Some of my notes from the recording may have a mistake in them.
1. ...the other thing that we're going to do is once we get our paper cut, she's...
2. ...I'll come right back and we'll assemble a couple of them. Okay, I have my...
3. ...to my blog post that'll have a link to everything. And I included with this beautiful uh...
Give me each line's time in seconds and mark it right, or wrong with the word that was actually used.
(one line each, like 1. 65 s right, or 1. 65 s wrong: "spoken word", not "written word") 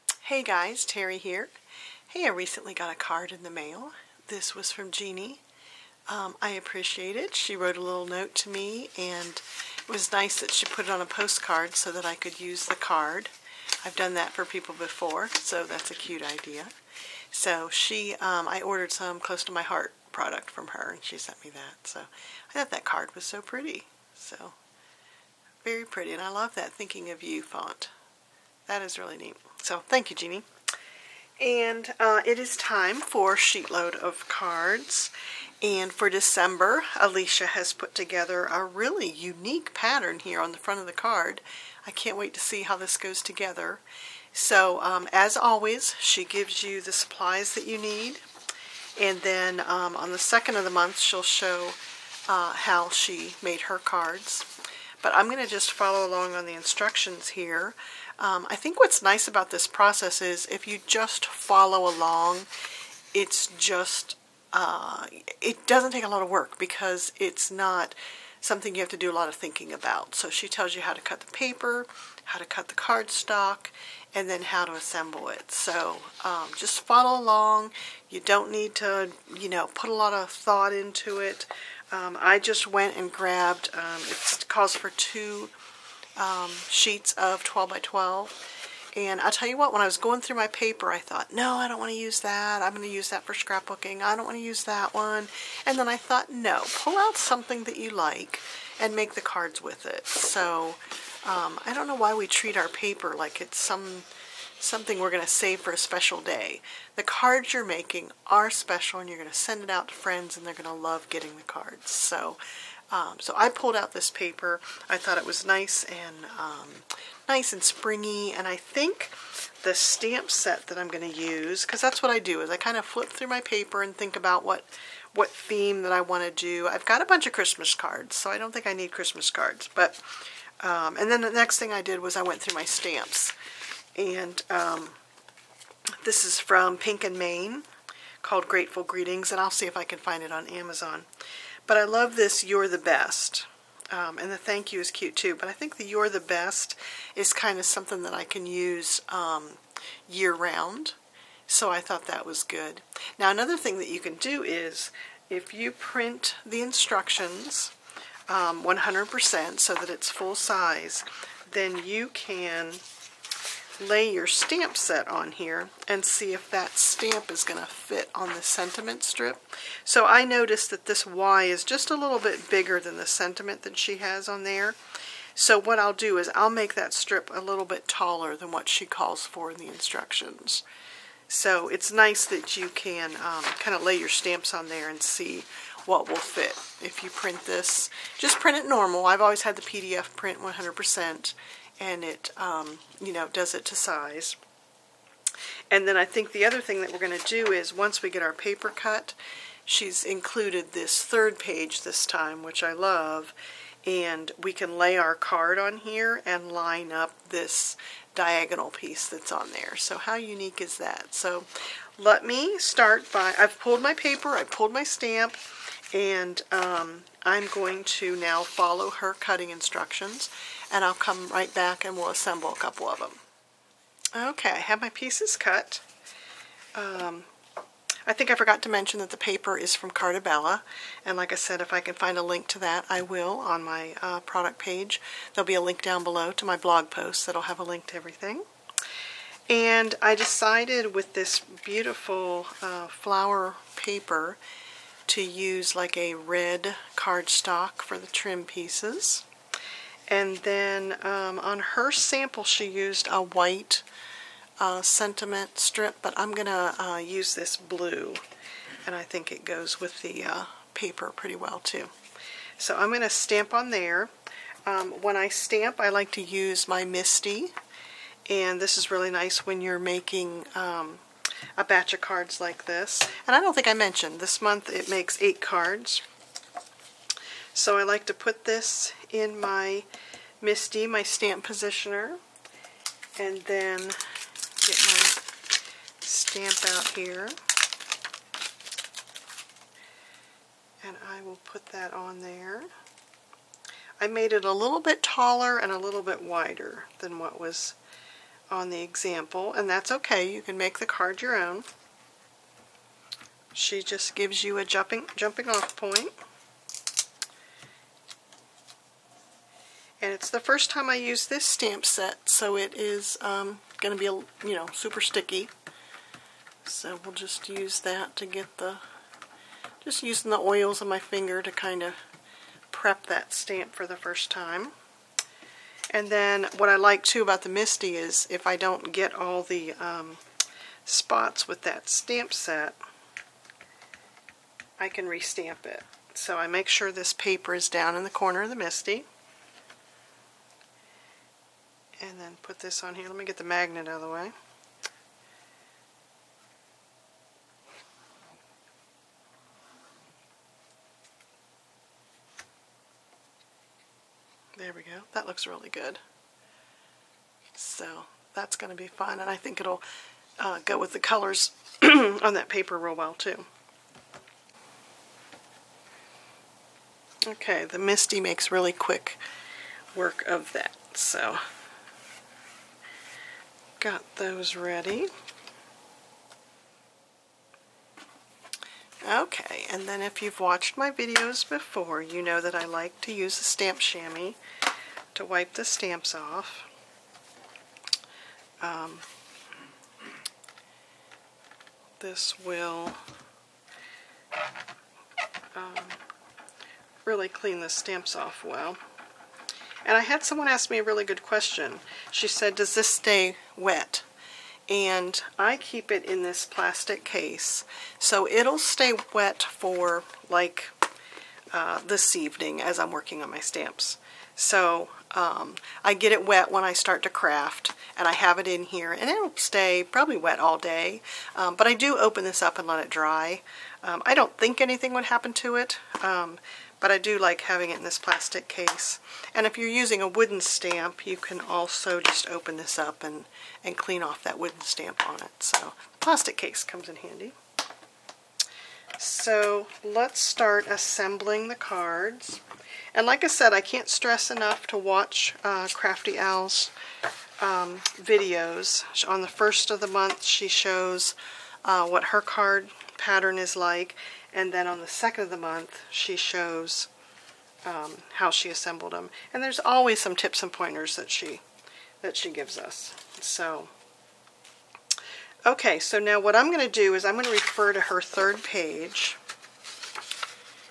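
1. 196 s right
2. 220 s right
3. 236 s wrong: "decided", not "included".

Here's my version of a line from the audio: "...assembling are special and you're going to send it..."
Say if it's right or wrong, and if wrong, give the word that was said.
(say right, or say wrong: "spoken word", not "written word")
wrong: "making", not "assembling".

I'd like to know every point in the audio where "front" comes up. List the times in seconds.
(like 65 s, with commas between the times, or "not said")
40 s.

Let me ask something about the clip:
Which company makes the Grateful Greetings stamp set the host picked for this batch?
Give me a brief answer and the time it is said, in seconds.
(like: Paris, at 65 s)
Pink and Main, at 136 s.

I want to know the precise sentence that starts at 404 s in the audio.
And I keep it in this plastic case.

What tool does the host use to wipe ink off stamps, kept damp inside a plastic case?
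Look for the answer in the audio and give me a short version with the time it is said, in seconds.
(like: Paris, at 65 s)
Stamp chamois, at 383 s.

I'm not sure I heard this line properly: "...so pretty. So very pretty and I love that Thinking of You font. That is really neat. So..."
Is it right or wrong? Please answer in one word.
right.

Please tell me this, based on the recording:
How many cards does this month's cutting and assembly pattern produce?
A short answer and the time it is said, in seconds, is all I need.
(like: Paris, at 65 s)
8, at 275 s.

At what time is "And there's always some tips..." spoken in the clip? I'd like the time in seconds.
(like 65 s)
459 s.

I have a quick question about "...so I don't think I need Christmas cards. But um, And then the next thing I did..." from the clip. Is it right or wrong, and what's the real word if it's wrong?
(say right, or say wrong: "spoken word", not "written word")
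right.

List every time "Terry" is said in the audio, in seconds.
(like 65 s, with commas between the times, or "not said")
0 s.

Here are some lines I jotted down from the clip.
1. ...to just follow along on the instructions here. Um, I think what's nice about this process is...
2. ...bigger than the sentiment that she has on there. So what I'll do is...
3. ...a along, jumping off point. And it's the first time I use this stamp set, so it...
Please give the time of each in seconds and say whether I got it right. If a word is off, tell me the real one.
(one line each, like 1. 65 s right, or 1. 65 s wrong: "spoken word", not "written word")
1. 55 s right
2. 172 s right
3. 304 s wrong: "jumping", not "along".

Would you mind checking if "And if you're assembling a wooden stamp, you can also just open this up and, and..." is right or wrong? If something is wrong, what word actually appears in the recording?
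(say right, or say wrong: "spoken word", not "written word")
wrong: "using", not "assembling".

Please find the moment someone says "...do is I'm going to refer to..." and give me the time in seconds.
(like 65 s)
466 s.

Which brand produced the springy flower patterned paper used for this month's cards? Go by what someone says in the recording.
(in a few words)
Carta Bella.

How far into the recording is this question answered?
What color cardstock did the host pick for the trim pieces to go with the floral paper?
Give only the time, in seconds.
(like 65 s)
246 s.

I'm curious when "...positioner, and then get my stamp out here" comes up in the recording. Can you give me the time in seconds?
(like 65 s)
281 s.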